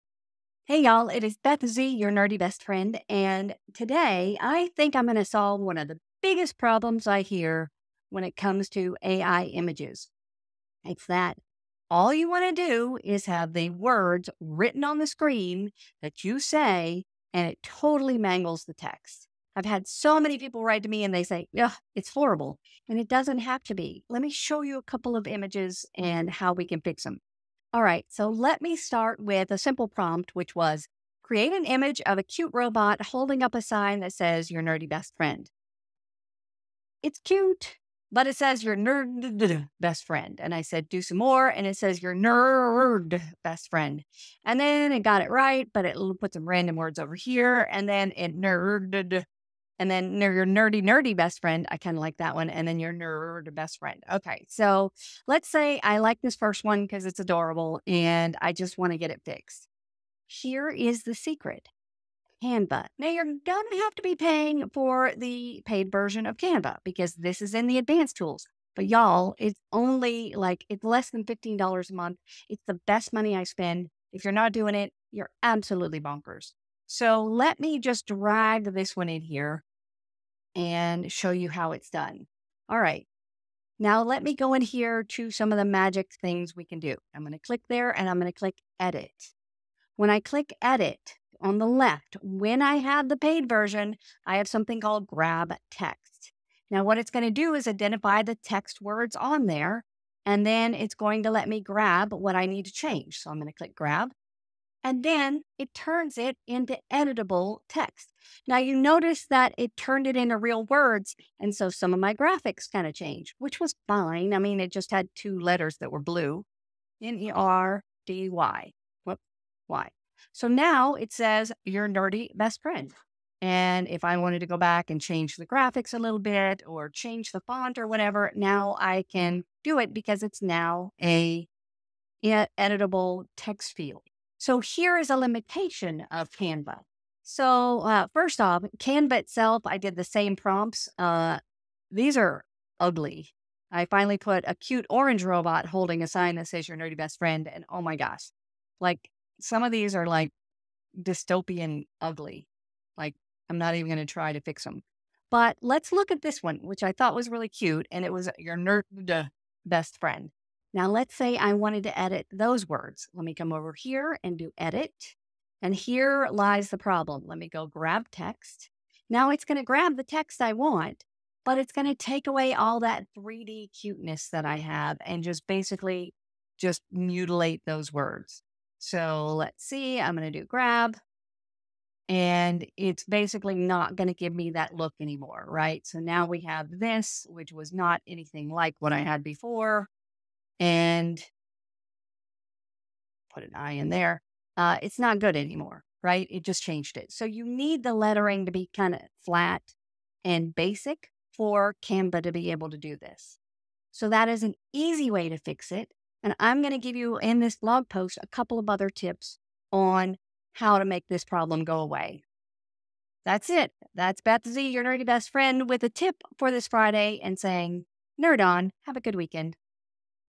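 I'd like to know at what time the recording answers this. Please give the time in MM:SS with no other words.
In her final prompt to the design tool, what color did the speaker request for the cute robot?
02:24.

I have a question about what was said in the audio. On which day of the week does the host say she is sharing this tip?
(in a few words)
Friday.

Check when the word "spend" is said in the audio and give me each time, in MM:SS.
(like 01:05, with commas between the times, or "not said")
01:13.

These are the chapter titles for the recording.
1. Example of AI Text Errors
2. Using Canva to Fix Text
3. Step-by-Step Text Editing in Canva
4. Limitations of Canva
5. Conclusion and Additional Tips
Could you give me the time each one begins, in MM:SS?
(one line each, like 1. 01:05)
1. 00:27
2. 01:02
3. 01:22
4. 02:14
5. 03:26.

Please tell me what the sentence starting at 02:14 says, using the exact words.
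So here is a limitation of Canva.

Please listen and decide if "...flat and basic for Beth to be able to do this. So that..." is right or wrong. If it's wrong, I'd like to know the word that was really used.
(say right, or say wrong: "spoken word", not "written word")
wrong: "Canva", not "Beth".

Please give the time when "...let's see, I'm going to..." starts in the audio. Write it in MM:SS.
02:59.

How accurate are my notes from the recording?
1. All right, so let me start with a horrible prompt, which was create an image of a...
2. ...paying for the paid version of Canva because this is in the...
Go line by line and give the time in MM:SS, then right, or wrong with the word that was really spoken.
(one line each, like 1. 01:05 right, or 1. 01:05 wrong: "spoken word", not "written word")
1. 00:27 wrong: "simple", not "horrible"
2. 01:04 right.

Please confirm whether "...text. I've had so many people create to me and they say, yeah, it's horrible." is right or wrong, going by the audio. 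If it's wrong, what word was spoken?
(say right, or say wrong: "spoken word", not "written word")
wrong: "write", not "create".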